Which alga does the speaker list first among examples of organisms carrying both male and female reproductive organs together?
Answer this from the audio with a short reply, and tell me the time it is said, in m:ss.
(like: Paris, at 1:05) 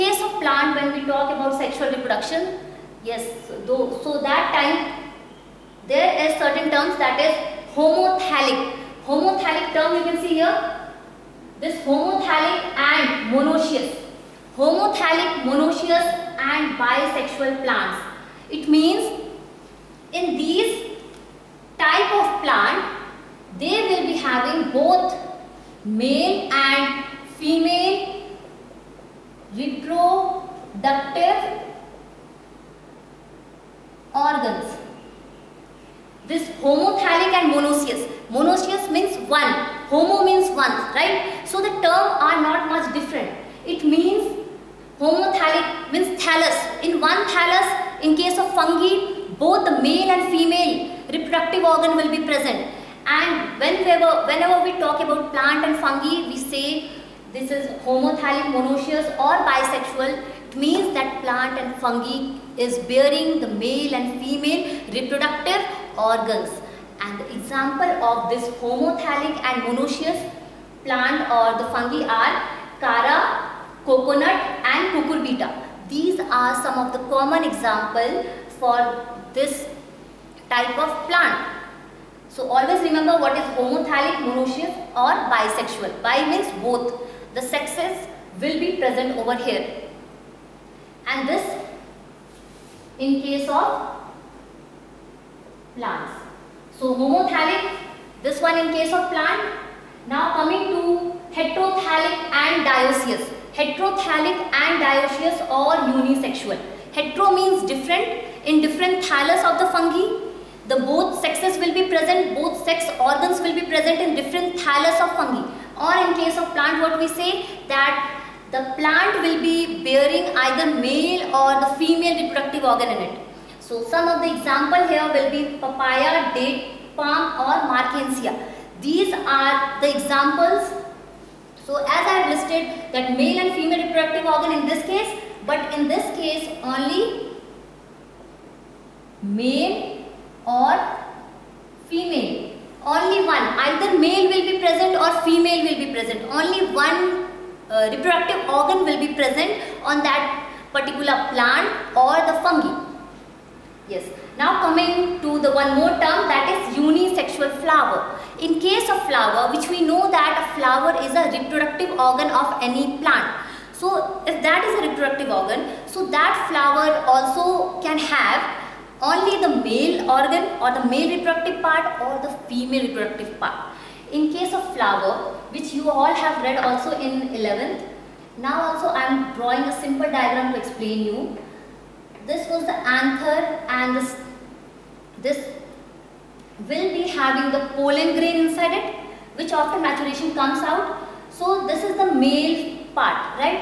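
Chara, at 1:12.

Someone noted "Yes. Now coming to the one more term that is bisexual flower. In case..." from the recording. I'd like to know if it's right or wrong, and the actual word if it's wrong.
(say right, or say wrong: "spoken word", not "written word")
wrong: "unisexual", not "bisexual".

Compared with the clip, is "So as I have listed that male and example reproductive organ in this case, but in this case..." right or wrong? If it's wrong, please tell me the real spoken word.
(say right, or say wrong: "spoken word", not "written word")
wrong: "female", not "example".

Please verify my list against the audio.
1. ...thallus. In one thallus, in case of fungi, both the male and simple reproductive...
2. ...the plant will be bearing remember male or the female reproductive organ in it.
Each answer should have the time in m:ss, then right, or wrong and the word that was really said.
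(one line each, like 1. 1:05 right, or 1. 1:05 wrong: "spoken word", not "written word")
1. 0:46 wrong: "female", not "simple"
2. 1:58 wrong: "either", not "remember".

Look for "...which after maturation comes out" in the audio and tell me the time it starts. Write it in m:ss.
3:09.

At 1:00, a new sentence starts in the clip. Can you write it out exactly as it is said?
It means that plant and fungi is bearing the male and female reproductive organs.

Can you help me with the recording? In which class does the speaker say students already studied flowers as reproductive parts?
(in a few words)
11th.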